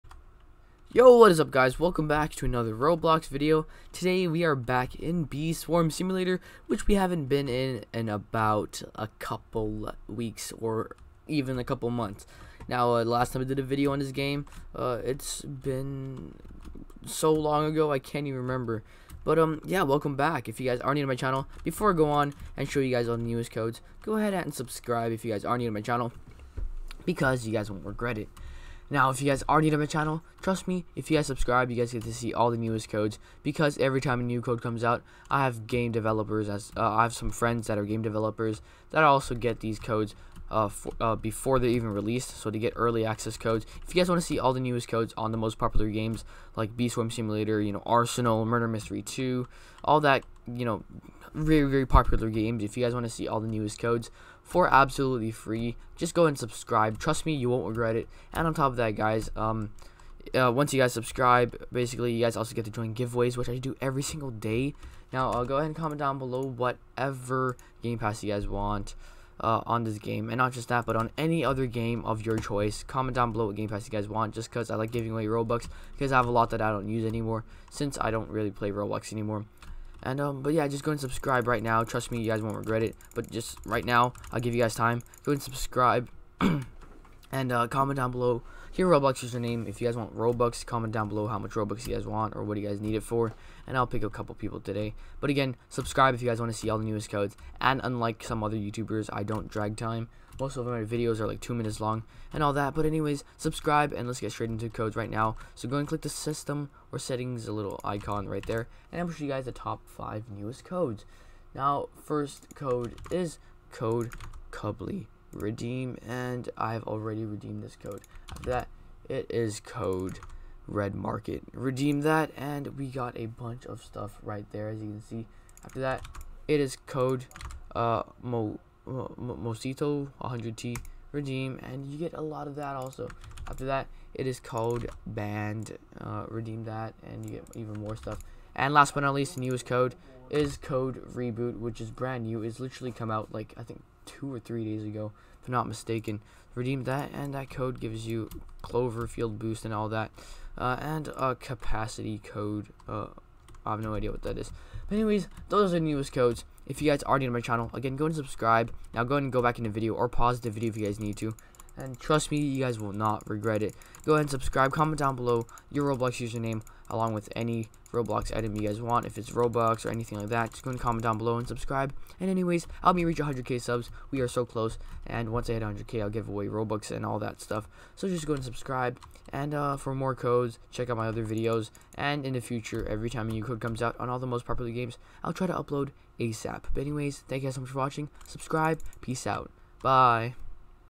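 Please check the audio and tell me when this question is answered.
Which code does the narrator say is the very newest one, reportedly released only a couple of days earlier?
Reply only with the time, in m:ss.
2:21.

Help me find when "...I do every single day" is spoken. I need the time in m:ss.
1:03.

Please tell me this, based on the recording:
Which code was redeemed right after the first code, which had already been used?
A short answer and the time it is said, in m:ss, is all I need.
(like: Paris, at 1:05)
red market, at 2:00.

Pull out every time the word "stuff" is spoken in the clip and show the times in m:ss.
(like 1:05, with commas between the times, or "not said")
2:03, 2:17, 2:57.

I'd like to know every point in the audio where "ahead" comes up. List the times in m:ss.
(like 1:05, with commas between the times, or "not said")
0:24, 1:05, 2:44.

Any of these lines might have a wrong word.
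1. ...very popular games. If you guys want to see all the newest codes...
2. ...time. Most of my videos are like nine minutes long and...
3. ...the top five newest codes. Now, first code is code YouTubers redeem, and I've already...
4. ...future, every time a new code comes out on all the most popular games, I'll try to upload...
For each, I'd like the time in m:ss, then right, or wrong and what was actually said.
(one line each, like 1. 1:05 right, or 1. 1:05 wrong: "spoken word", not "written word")
1. 0:51 right
2. 1:39 wrong: "two", not "nine"
3. 1:49 wrong: "Cubly", not "YouTubers"
4. 3:02 right.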